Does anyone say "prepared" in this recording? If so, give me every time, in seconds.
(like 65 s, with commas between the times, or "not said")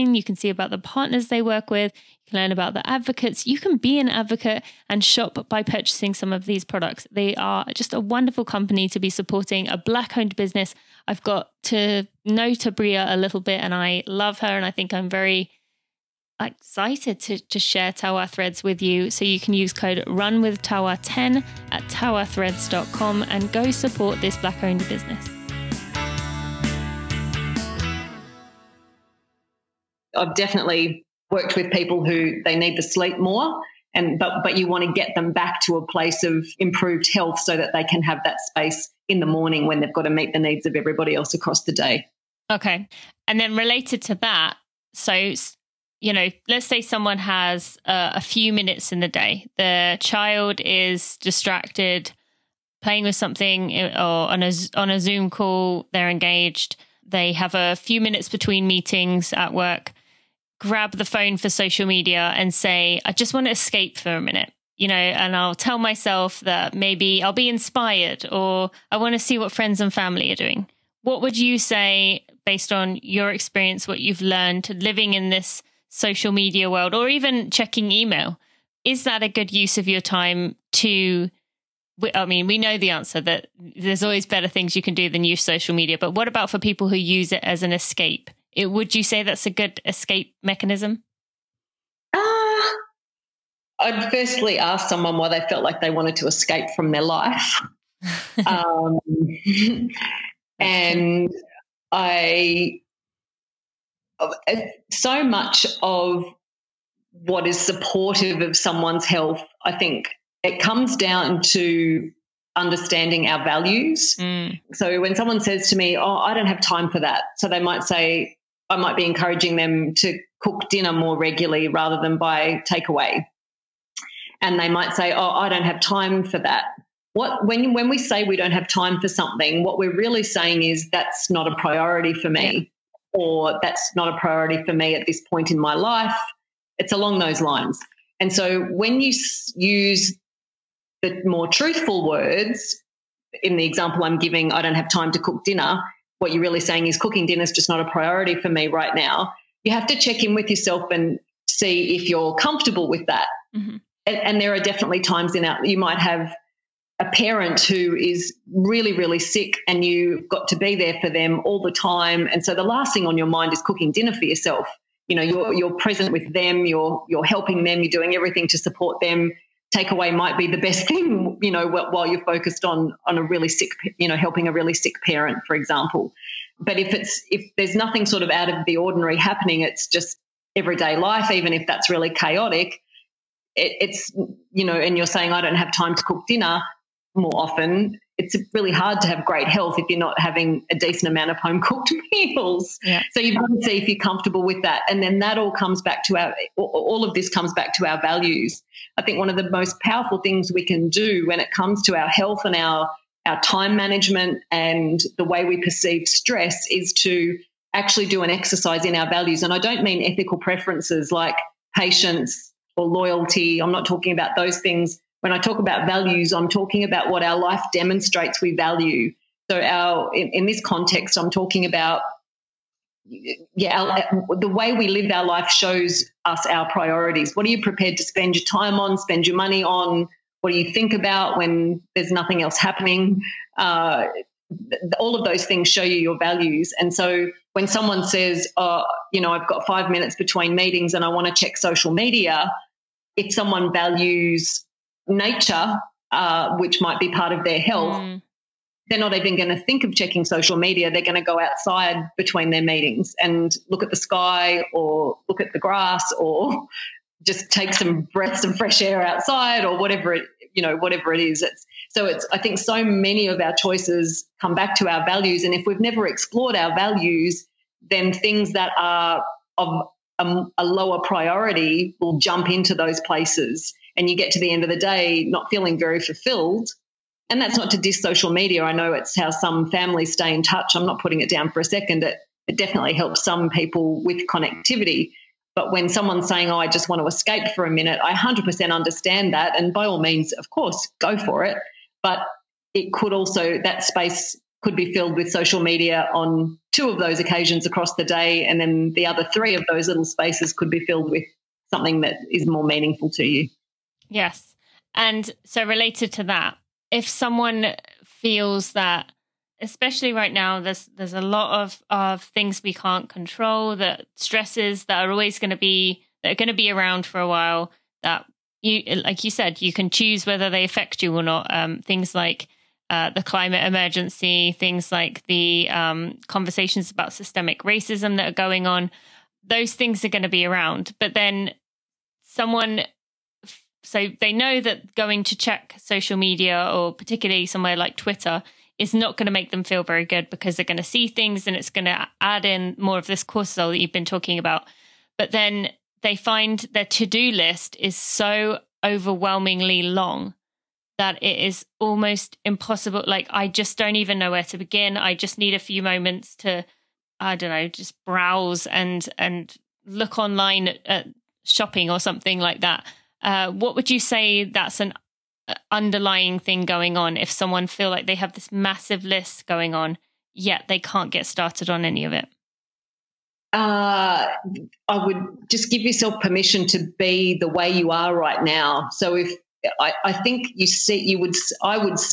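227 s.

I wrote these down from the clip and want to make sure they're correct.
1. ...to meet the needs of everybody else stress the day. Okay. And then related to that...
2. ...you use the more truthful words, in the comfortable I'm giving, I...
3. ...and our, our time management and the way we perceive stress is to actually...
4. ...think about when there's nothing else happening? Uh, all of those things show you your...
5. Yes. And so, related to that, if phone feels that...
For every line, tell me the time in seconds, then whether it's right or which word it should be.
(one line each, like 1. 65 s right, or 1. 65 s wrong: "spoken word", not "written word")
1. 40 s wrong: "across", not "stress"
2. 139 s wrong: "example", not "comfortable"
3. 202 s right
4. 230 s right
5. 304 s wrong: "someone", not "phone".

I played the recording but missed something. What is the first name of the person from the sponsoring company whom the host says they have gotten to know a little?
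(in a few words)
Tabria.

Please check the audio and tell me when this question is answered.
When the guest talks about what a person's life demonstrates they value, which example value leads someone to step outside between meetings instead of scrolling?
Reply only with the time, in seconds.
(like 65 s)
245 s.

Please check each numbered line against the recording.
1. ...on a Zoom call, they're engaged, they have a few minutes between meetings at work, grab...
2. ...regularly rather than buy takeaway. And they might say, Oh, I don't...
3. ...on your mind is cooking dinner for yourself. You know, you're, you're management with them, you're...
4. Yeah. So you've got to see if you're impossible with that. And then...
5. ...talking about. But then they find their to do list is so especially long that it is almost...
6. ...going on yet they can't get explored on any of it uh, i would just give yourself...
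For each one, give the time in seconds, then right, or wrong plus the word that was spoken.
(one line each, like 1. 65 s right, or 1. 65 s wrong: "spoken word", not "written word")
1. 54 s right
2. 121 s right
3. 163 s wrong: "present", not "management"
4. 192 s wrong: "comfortable", not "impossible"
5. 344 s wrong: "overwhelmingly", not "especially"
6. 369 s wrong: "started", not "explored".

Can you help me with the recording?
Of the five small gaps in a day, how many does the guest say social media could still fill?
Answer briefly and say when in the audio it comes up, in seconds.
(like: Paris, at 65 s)
2, at 296 s.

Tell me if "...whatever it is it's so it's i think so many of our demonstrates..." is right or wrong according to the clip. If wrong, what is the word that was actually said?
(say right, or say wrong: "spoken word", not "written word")
wrong: "choices", not "demonstrates".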